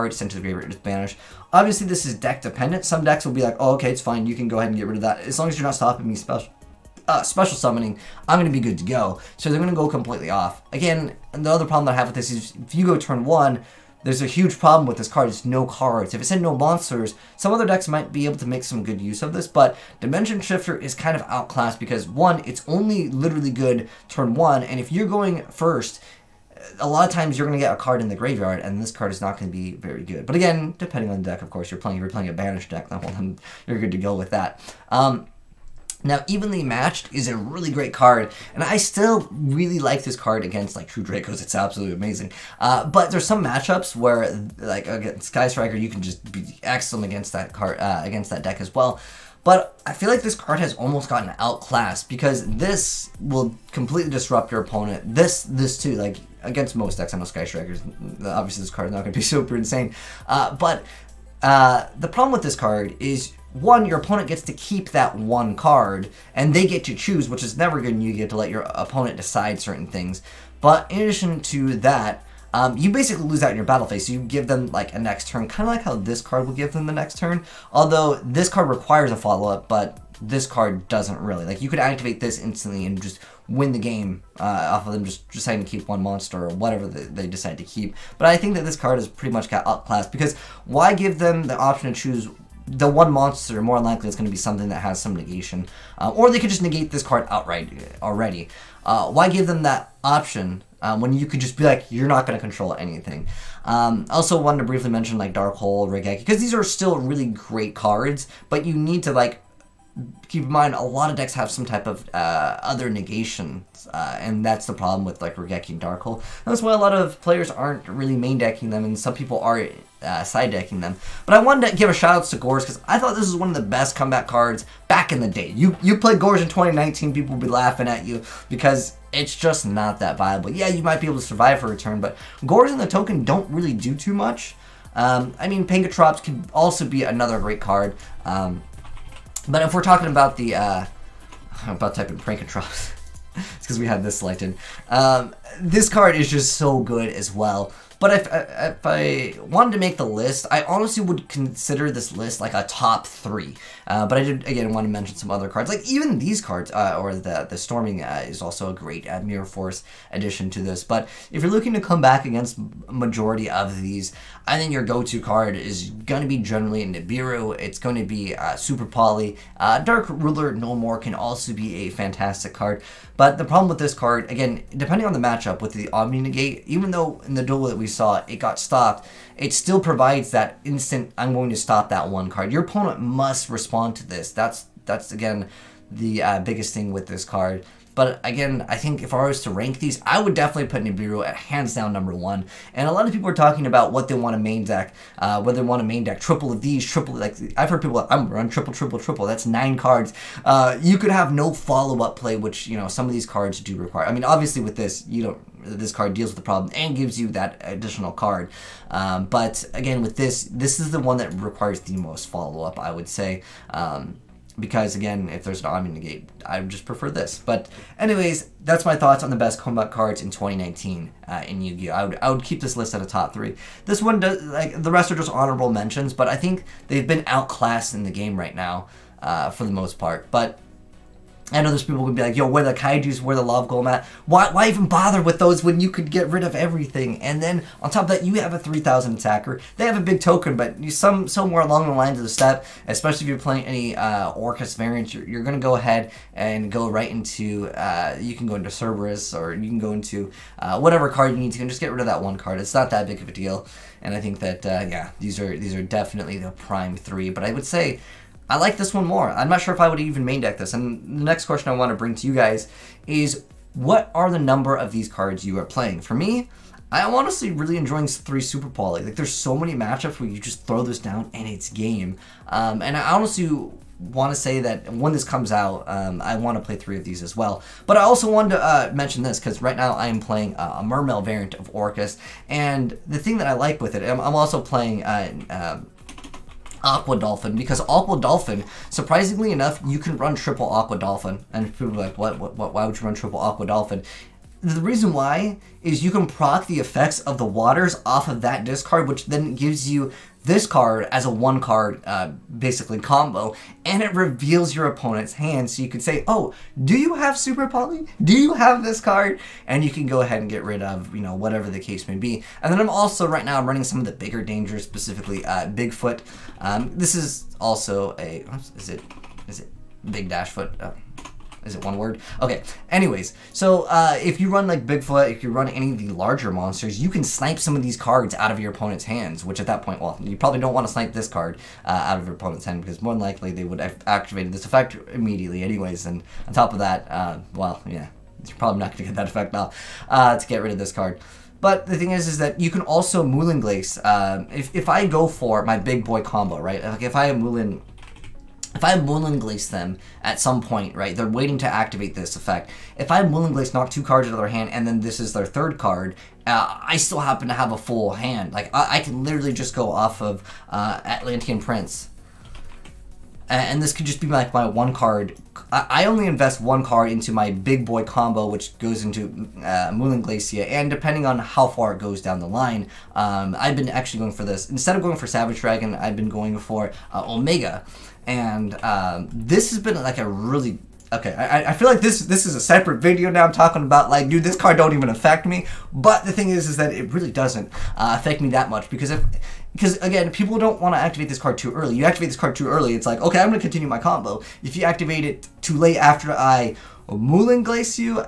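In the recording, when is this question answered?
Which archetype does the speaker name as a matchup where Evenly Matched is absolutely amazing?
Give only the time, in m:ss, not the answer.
0:40.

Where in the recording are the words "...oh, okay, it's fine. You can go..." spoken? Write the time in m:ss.
0:03.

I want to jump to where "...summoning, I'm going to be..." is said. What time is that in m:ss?
0:07.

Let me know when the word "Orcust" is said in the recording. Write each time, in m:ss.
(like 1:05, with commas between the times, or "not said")
4:04, 4:41.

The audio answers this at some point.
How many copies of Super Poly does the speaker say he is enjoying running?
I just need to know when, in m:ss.
4:28.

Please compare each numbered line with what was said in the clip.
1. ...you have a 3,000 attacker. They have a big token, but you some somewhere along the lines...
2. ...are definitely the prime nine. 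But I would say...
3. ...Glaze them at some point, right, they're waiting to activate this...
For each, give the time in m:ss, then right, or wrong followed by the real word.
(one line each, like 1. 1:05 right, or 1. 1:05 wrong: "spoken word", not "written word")
1. 3:58 right
2. 4:15 wrong: "three", not "nine"
3. 5:49 right.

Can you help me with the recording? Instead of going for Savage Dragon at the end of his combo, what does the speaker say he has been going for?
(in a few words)
Omega.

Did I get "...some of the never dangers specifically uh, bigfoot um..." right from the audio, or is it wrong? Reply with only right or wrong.
wrong.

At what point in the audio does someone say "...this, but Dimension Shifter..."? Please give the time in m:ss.
0:19.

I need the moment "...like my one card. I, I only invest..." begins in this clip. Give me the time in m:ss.
6:04.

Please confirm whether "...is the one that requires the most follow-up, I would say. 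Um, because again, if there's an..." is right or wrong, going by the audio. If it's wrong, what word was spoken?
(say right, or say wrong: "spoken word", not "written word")
right.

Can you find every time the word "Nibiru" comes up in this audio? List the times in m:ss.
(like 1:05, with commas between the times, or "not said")
2:46, 3:10.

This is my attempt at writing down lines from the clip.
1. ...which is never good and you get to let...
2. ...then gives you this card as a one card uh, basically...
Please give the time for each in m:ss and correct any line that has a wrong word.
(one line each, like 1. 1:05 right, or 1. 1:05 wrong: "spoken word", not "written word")
1. 1:07 right
2. 4:59 right.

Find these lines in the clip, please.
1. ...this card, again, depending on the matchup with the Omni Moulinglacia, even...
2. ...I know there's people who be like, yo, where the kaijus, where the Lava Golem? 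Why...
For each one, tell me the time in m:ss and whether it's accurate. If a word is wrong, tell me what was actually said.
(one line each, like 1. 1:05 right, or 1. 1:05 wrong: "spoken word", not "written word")
1. 2:53 wrong: "Negate", not "Moulinglacia"
2. 3:51 right.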